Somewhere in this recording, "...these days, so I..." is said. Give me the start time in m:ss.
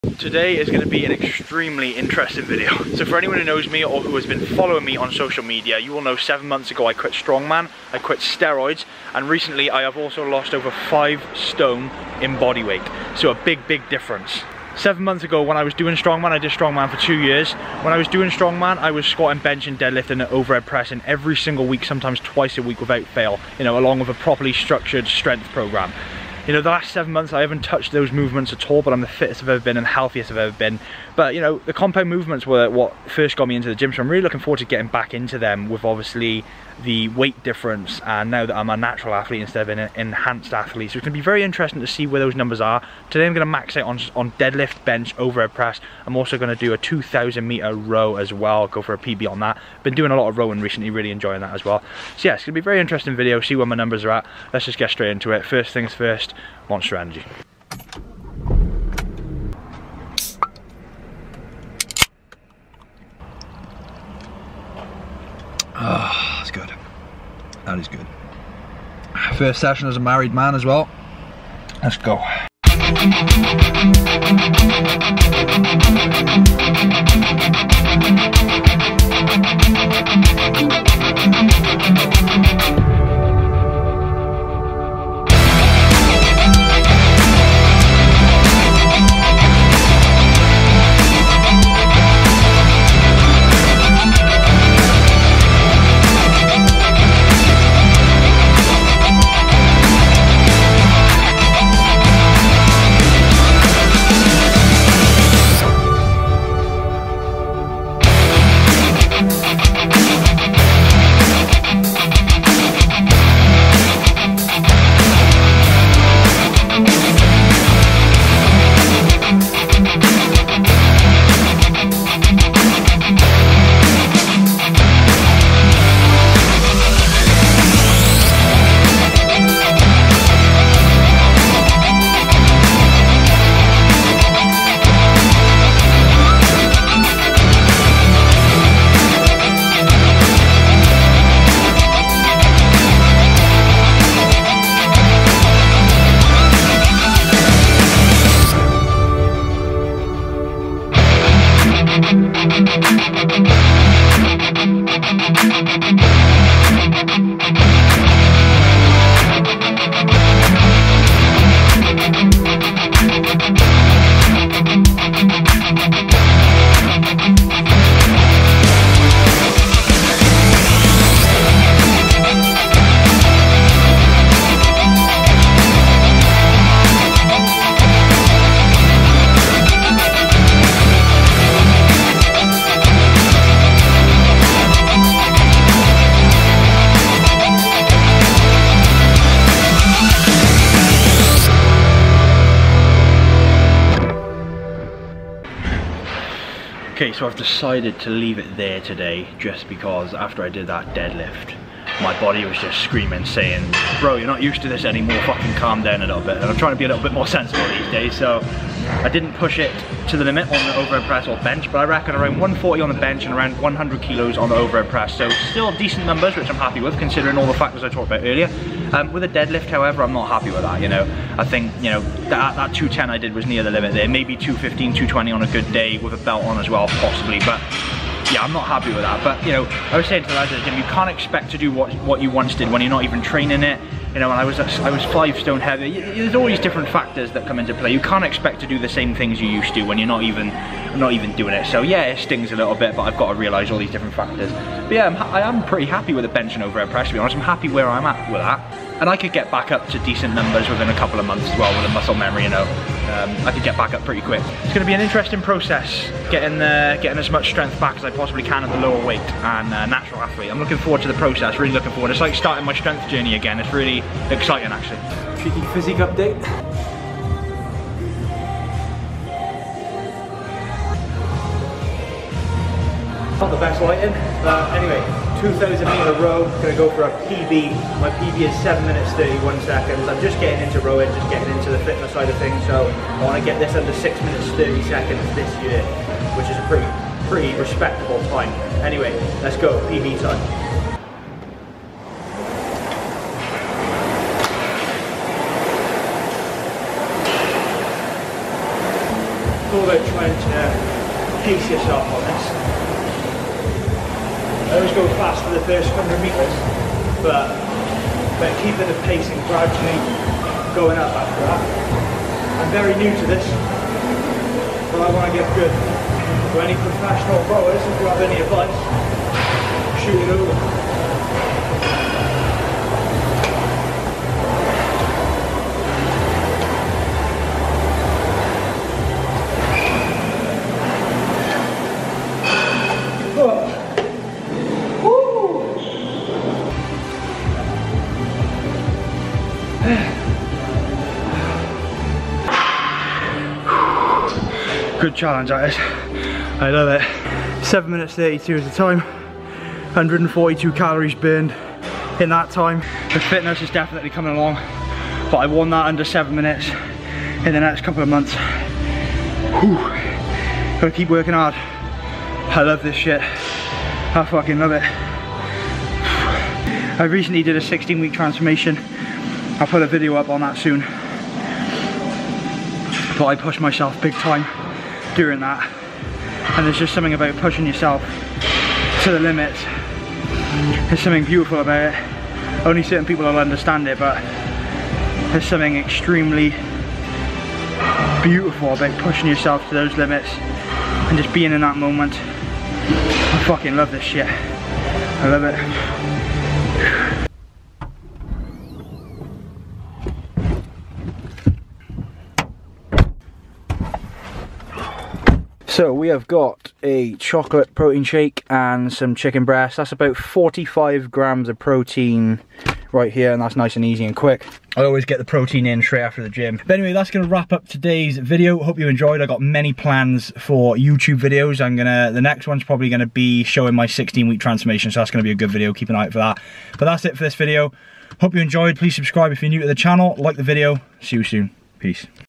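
3:27.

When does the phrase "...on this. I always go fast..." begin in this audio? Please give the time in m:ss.
5:02.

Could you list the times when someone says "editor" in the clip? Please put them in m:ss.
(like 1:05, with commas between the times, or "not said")
not said.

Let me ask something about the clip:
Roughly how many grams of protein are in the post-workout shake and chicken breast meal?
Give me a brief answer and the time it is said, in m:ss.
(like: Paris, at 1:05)
45 grams, at 6:50.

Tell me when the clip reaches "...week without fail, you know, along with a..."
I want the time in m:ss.
0:22.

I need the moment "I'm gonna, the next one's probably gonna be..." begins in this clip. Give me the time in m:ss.
7:01.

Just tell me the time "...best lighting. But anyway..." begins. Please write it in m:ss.
4:33.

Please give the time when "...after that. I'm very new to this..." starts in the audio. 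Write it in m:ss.
5:11.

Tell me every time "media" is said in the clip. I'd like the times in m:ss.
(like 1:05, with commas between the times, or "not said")
0:05.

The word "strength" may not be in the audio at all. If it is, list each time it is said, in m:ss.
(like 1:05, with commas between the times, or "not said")
0:25, 4:17, 4:22.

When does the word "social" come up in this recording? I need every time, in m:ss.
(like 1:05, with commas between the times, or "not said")
0:05.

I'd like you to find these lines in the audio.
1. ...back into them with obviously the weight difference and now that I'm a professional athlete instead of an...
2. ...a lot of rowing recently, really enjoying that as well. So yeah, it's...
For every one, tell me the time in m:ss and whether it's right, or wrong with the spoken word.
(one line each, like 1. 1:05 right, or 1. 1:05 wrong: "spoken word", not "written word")
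1. 0:34 wrong: "natural", not "professional"
2. 0:50 right.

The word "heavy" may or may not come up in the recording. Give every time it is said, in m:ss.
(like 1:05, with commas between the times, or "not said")
3:55.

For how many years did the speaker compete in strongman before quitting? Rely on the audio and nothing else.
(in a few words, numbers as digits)
2 years.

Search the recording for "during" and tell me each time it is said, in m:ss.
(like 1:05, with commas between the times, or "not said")
6:15.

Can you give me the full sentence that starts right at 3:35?
So still decent numbers, which I'm happy with, considering all the factors I talked about earlier.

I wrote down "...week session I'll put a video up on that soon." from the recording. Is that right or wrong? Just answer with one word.
wrong.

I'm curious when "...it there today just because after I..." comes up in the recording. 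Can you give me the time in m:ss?
3:18.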